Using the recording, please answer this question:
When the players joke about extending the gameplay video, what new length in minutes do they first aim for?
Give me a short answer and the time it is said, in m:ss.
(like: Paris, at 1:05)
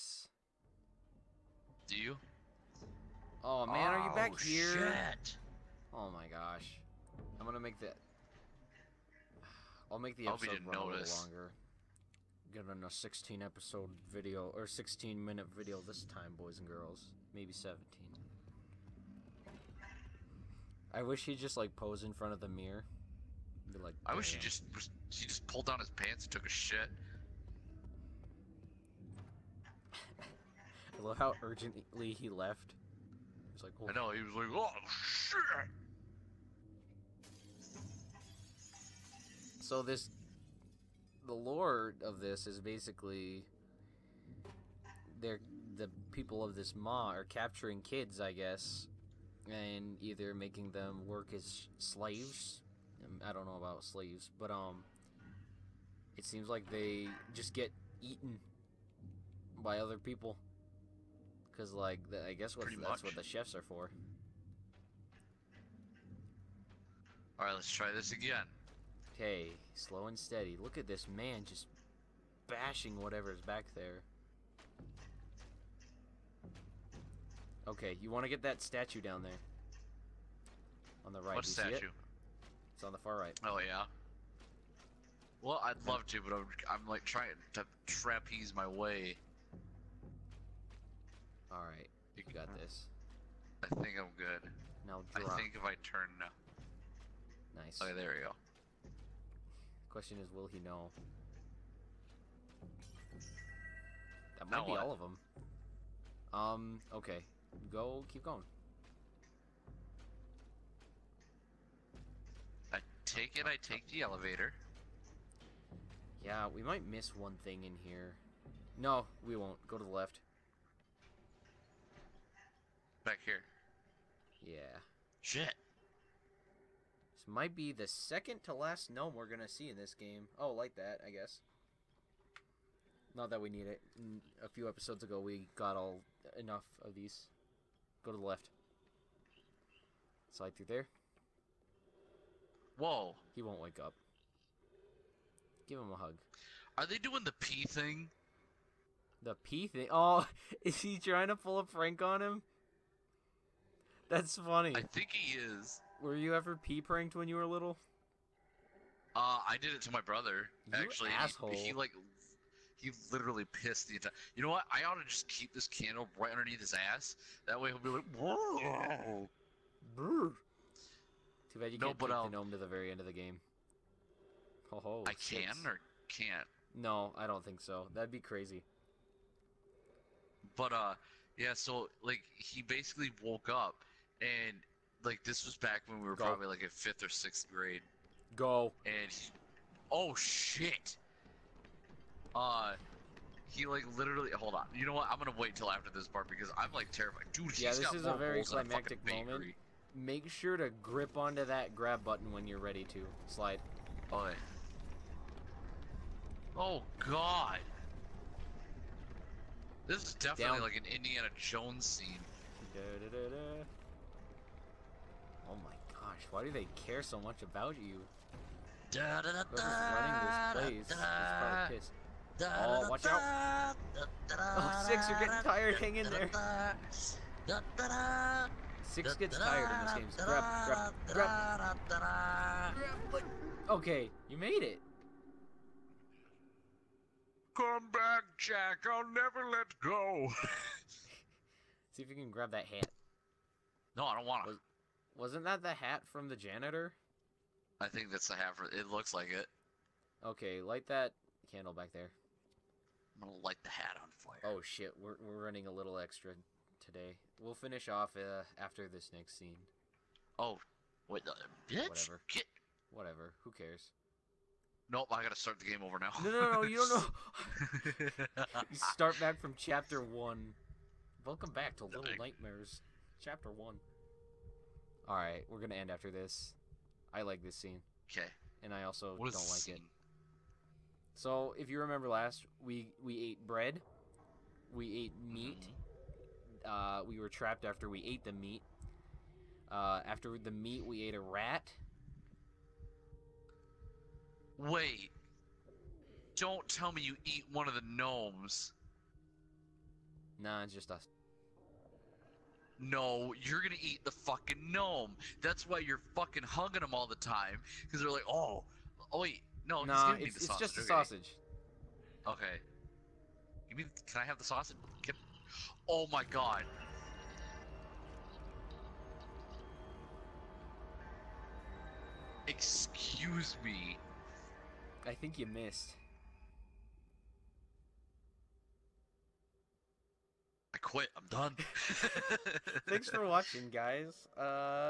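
16, at 0:14.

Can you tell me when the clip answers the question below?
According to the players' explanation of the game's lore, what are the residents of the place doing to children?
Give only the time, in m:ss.
0:47.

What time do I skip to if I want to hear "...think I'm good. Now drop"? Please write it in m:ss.
1:33.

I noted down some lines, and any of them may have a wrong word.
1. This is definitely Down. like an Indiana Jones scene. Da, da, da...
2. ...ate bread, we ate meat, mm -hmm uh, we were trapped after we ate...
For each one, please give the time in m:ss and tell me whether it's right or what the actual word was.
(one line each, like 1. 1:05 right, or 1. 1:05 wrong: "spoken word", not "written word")
1. 3:29 right
2. 4:43 right.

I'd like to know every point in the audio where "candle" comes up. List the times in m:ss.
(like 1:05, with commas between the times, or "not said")
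2:45, 4:11.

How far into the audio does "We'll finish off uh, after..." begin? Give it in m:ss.
4:17.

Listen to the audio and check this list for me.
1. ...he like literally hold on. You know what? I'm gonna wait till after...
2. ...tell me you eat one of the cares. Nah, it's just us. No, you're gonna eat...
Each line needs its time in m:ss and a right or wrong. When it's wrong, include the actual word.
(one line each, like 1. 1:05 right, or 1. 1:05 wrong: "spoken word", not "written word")
1. 3:13 right
2. 4:56 wrong: "gnomes", not "cares".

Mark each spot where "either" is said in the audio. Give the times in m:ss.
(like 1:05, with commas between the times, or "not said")
0:50.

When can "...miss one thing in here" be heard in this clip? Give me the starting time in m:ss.
1:56.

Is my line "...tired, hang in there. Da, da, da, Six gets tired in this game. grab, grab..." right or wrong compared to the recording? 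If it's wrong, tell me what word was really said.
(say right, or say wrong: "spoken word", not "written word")
right.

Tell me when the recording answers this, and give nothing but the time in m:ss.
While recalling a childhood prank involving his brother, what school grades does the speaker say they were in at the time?
3:06.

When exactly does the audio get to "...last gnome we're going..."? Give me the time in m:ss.
2:08.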